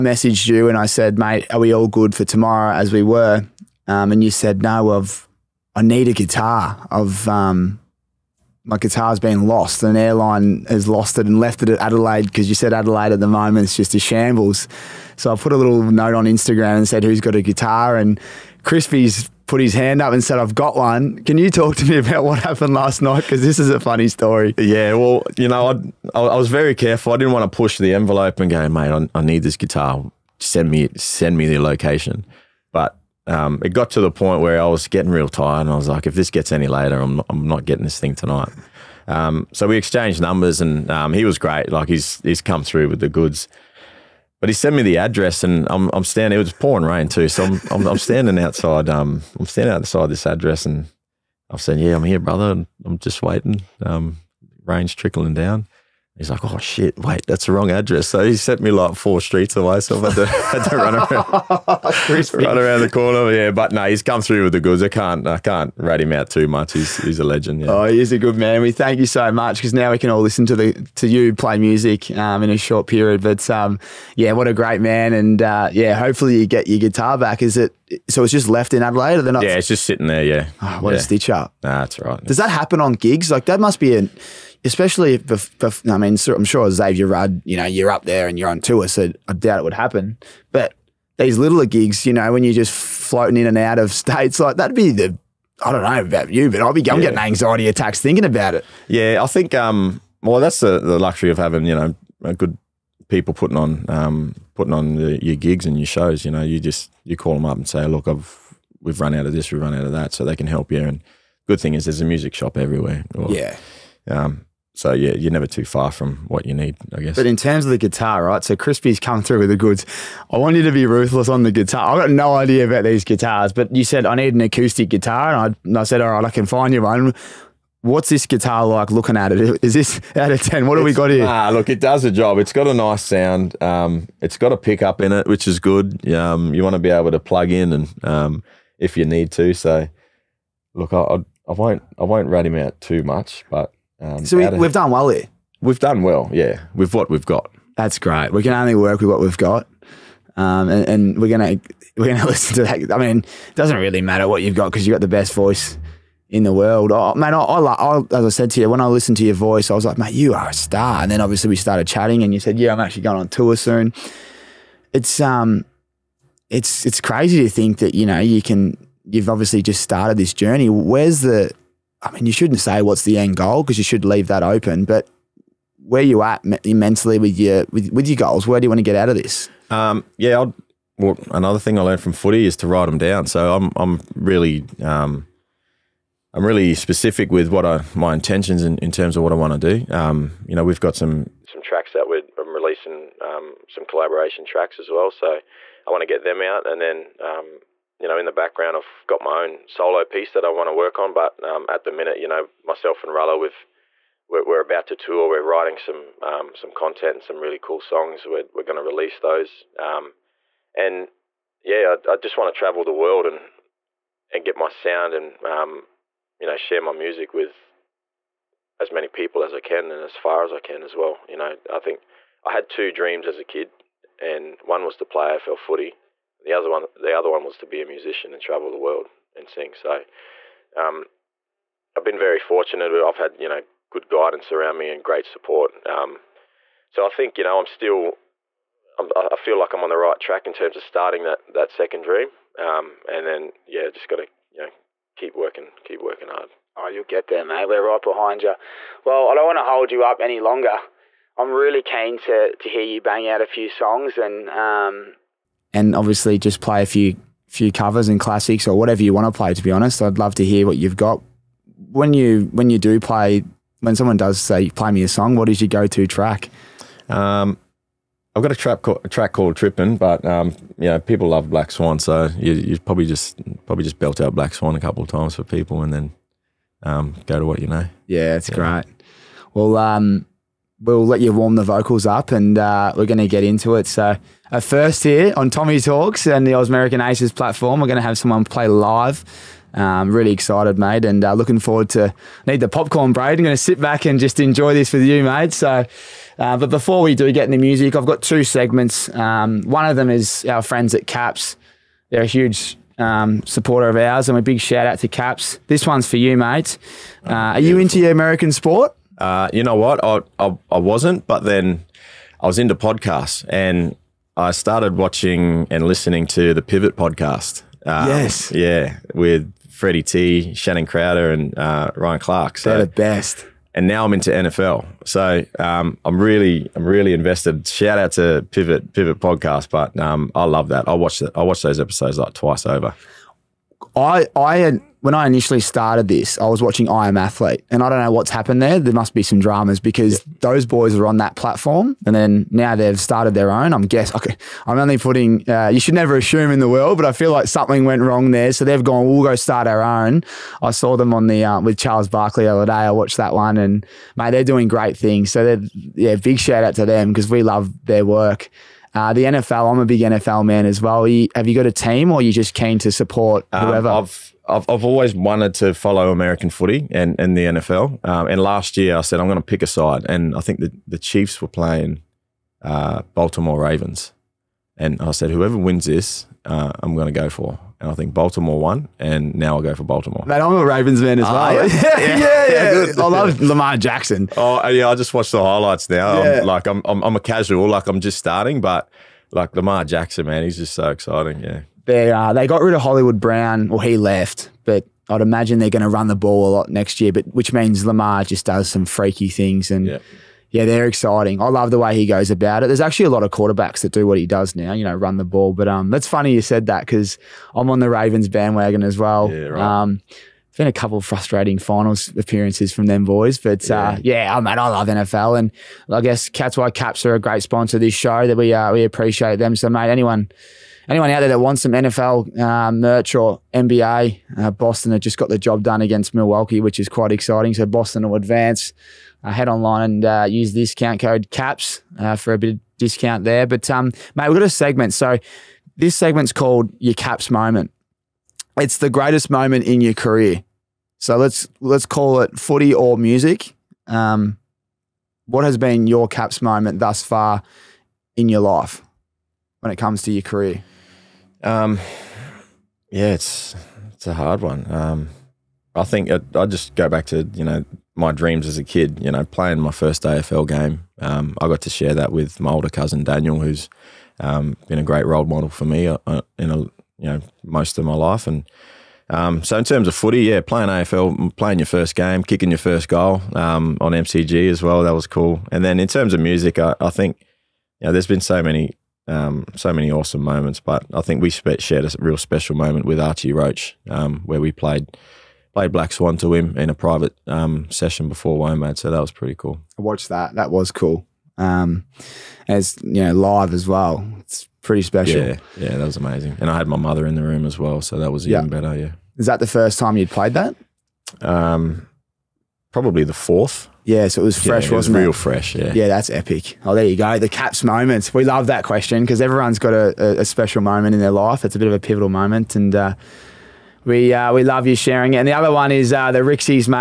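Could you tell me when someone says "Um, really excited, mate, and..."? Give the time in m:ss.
4:49.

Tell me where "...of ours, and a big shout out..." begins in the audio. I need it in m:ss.
5:03.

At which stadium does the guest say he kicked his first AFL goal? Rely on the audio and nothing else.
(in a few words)
MCG.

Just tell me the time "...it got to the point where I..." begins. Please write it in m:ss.
0:33.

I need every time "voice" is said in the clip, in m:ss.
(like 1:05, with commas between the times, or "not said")
2:35, 2:39.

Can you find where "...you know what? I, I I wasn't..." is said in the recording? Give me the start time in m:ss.
5:09.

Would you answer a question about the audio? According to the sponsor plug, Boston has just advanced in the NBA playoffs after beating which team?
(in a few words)
Milwaukee.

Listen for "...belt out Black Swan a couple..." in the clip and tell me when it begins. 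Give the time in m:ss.
4:33.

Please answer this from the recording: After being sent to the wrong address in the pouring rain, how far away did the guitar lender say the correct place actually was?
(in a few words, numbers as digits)
four streets away.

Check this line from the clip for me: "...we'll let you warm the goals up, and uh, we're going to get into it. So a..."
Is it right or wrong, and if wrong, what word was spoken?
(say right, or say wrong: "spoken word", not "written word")
wrong: "vocals", not "goals".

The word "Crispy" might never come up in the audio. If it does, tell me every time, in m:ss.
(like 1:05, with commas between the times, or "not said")
0:18, 1:58.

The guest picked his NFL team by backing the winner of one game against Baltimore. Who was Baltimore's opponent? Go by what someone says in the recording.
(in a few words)
Chiefs.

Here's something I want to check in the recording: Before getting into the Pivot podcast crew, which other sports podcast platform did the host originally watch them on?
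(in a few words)
I Am Athlete.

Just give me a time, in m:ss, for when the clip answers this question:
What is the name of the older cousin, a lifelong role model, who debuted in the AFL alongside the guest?
7:43.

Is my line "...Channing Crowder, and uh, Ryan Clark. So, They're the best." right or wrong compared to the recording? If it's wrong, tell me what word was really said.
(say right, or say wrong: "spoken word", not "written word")
right.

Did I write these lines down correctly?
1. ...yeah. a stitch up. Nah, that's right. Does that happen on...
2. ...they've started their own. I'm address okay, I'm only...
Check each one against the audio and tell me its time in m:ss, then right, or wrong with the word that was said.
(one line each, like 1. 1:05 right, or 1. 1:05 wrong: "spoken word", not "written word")
1. 1:20 right
2. 5:42 wrong: "guess", not "address".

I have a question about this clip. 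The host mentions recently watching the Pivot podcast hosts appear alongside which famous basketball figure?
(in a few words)
Charles Barkley.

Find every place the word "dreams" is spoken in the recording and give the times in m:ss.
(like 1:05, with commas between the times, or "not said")
3:42, 4:02, 7:38.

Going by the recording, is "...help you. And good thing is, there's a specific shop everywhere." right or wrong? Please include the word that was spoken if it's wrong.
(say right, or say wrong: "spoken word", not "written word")
wrong: "music", not "specific".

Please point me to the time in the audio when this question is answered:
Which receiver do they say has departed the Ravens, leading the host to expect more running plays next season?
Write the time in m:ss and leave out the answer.
6:32.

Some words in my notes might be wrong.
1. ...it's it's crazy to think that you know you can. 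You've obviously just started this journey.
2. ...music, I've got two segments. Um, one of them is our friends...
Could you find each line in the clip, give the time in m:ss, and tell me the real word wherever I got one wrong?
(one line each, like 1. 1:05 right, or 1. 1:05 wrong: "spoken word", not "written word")
1. 2:46 right
2. 4:57 right.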